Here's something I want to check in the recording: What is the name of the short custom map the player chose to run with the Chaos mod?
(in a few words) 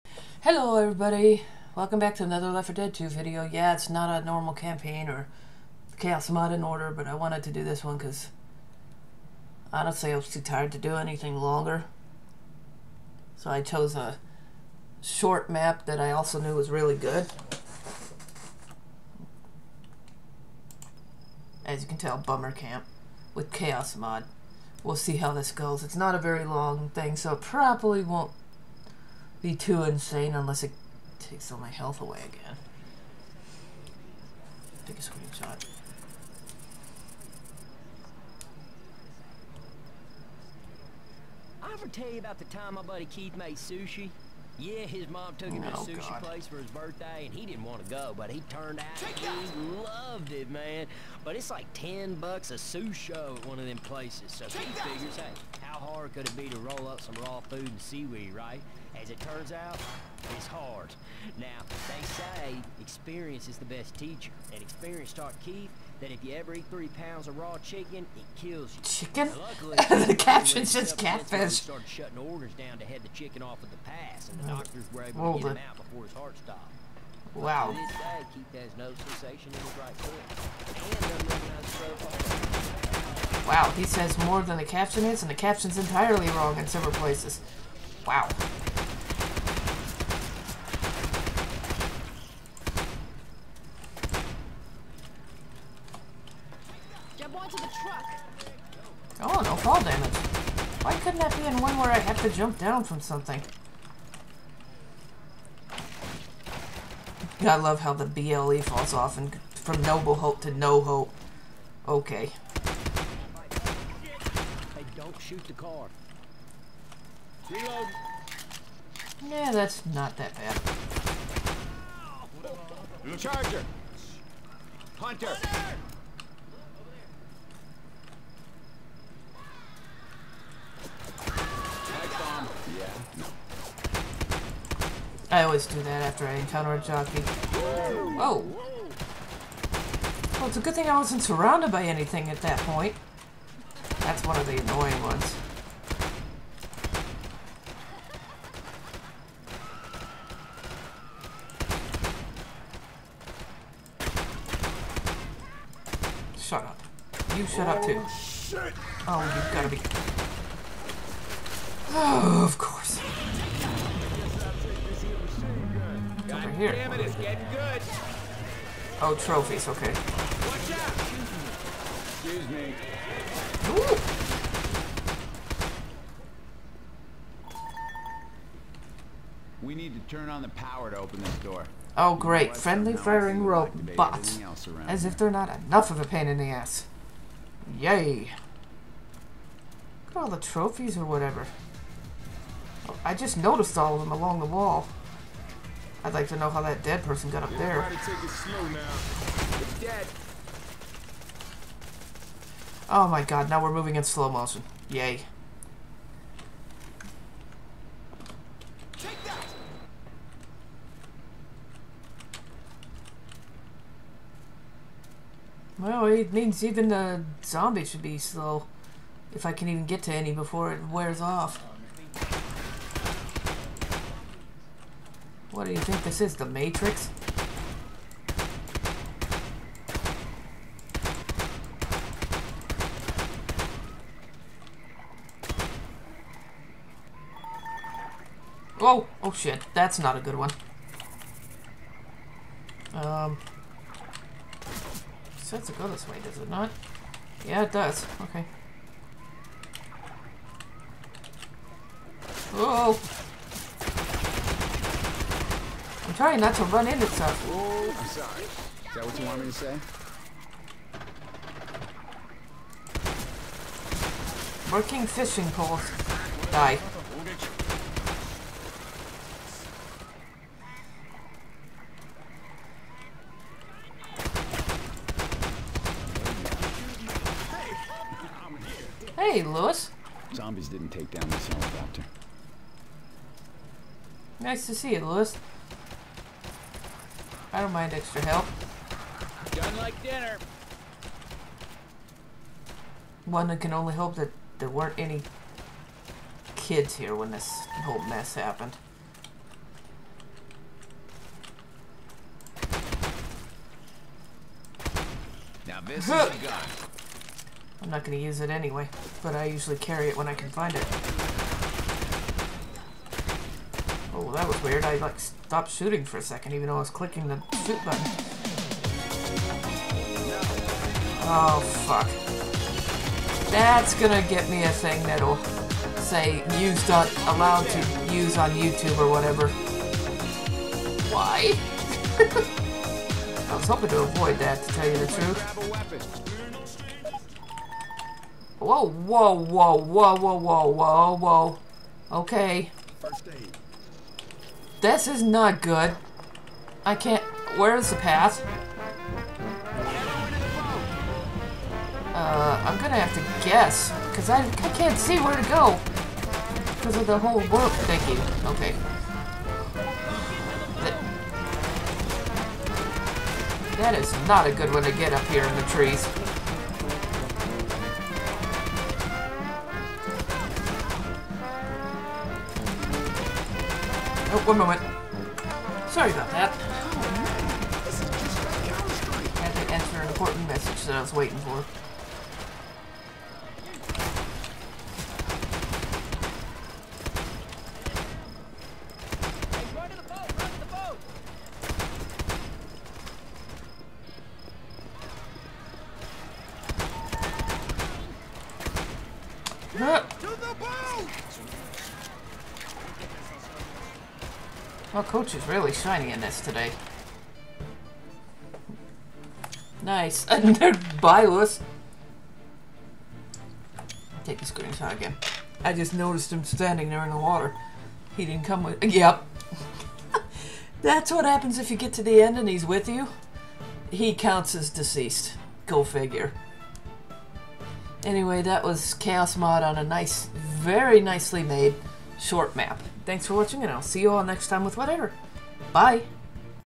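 Bummer Camp.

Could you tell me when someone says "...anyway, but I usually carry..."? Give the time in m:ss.
5:08.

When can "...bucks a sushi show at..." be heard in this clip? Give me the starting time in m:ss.
0:52.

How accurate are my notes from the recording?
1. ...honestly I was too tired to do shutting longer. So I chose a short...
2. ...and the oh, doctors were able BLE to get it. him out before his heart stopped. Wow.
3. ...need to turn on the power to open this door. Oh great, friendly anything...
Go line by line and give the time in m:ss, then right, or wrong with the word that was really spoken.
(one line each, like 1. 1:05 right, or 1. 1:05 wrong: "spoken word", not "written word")
1. 0:09 wrong: "anything", not "shutting"
2. 1:14 wrong: "Hold", not "BLE"
3. 2:59 wrong: "firing", not "anything".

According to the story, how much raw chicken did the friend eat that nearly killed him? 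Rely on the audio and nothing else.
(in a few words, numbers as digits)
3 pounds.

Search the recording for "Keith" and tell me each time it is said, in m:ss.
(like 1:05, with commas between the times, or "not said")
0:43, 1:05.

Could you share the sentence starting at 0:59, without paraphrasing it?
As it turns out, it's hard.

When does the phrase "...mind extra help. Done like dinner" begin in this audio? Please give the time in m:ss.
4:47.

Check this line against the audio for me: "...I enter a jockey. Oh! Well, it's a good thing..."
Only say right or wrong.
wrong.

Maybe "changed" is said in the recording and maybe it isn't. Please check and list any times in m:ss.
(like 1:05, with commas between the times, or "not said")
not said.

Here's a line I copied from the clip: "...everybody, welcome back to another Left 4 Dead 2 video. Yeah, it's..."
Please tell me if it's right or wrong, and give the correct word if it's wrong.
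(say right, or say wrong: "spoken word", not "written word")
right.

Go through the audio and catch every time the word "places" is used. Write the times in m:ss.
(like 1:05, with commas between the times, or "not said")
0:46, 0:53, 1:26.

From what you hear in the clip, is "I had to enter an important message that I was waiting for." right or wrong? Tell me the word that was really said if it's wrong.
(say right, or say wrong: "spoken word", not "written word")
right.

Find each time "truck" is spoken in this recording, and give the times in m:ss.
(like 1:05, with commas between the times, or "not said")
1:37.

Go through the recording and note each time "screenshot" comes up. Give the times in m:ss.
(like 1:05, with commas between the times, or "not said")
0:35, 6:54.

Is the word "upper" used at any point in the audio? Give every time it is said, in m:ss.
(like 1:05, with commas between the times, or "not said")
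not said.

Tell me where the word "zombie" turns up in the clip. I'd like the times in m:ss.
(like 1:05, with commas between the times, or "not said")
3:37, 4:40.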